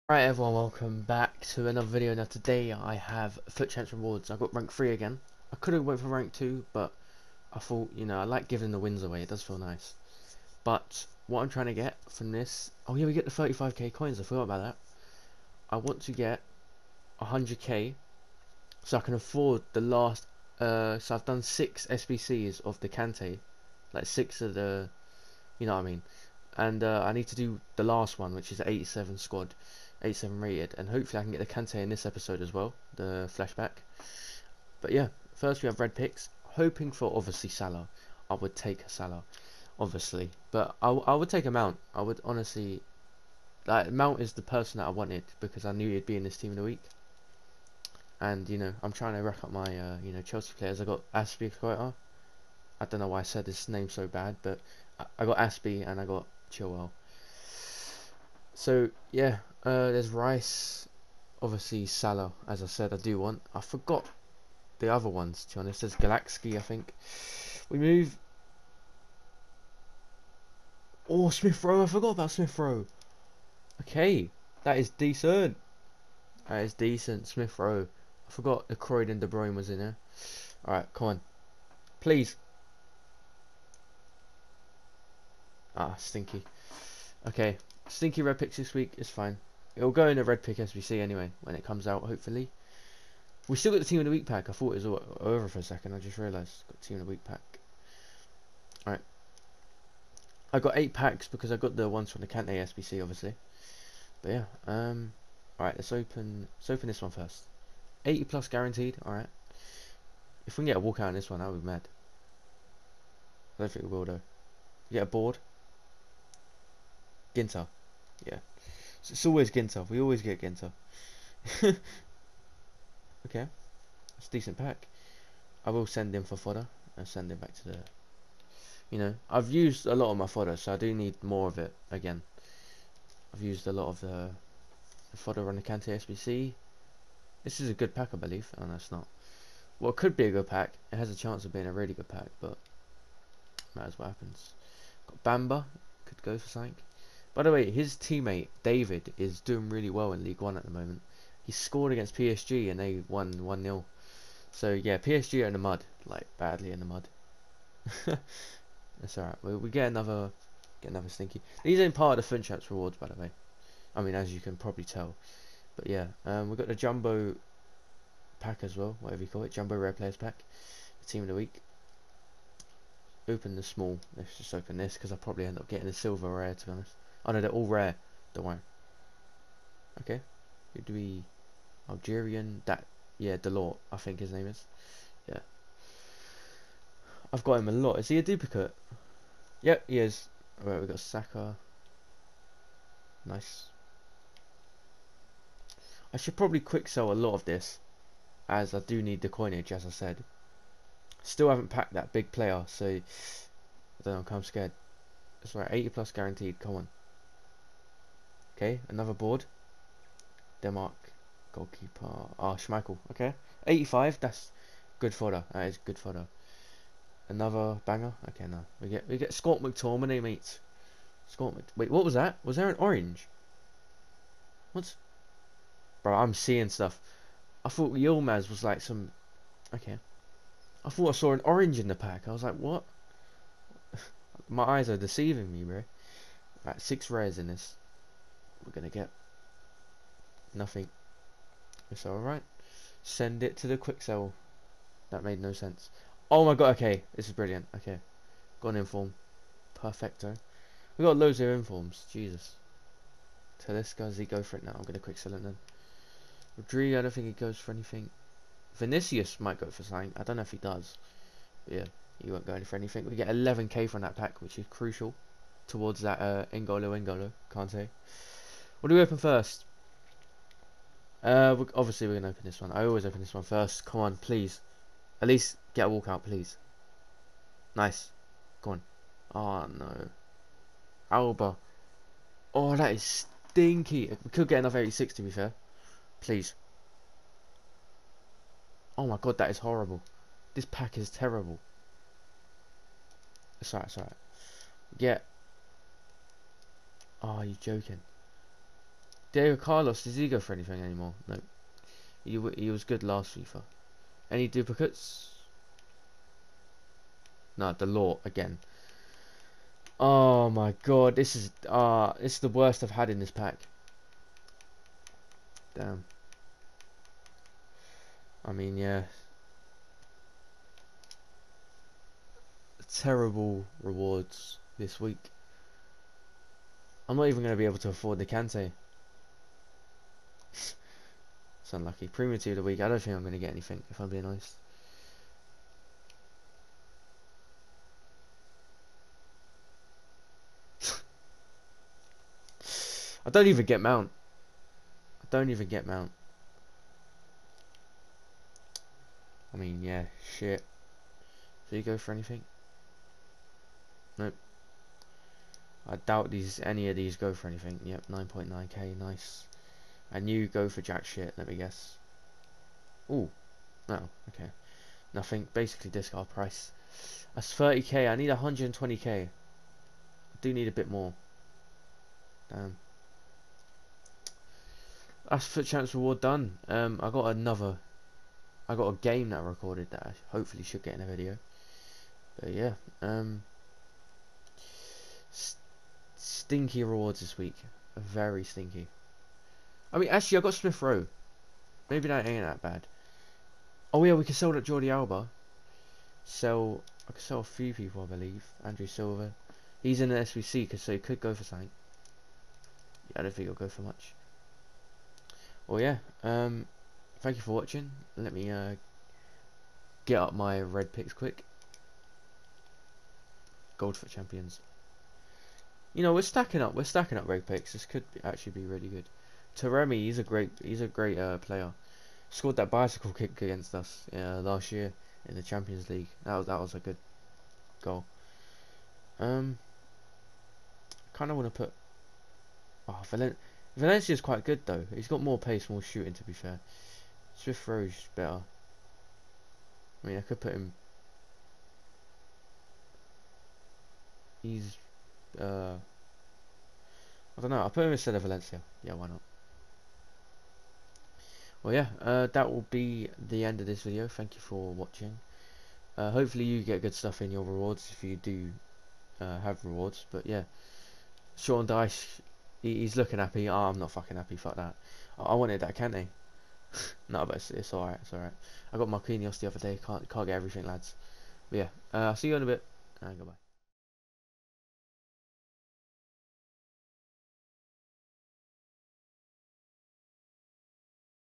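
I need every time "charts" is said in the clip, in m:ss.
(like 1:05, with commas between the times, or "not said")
not said.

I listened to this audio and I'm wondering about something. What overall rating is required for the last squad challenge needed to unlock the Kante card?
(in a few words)
87.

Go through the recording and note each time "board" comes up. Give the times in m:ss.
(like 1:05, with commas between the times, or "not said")
1:55, 3:29.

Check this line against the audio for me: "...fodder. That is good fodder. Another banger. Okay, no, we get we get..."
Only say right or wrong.
right.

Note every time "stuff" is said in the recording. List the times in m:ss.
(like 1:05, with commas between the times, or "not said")
3:46, 7:36.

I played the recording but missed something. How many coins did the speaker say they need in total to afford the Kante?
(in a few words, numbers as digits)
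120k.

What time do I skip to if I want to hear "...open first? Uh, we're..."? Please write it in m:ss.
4:29.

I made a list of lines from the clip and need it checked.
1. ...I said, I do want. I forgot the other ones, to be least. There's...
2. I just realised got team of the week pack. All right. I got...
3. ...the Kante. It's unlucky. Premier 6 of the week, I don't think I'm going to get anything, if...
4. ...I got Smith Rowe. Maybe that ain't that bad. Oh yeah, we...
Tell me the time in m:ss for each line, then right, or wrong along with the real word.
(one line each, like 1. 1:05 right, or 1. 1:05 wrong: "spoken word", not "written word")
1. 1:02 wrong: "honest", not "least"
2. 1:35 right
3. 5:28 wrong: "2", not "6"
4. 6:30 right.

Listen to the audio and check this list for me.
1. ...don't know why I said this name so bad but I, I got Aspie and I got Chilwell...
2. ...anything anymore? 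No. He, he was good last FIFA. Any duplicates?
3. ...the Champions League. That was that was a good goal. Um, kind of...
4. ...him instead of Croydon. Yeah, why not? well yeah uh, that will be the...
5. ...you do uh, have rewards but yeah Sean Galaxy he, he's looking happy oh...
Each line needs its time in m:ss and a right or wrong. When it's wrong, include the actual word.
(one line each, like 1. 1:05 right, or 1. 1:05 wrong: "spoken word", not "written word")
1. 0:52 right
2. 5:00 right
3. 7:05 right
4. 7:27 wrong: "Valencia", not "Croydon"
5. 7:38 wrong: "Dyche", not "Galaxy".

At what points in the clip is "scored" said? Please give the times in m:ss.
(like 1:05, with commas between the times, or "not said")
2:31, 7:02.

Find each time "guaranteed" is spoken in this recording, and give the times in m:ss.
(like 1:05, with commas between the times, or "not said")
1:48, 3:26.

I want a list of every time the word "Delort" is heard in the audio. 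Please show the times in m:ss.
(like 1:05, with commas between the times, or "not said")
3:03, 5:07.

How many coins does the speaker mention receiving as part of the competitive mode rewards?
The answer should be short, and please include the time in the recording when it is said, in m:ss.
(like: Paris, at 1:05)
35k, at 0:13.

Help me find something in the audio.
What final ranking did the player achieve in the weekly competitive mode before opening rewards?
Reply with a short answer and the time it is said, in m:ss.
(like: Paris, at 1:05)
Rank 3, at 0:04.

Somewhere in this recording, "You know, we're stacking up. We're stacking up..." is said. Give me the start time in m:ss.
6:55.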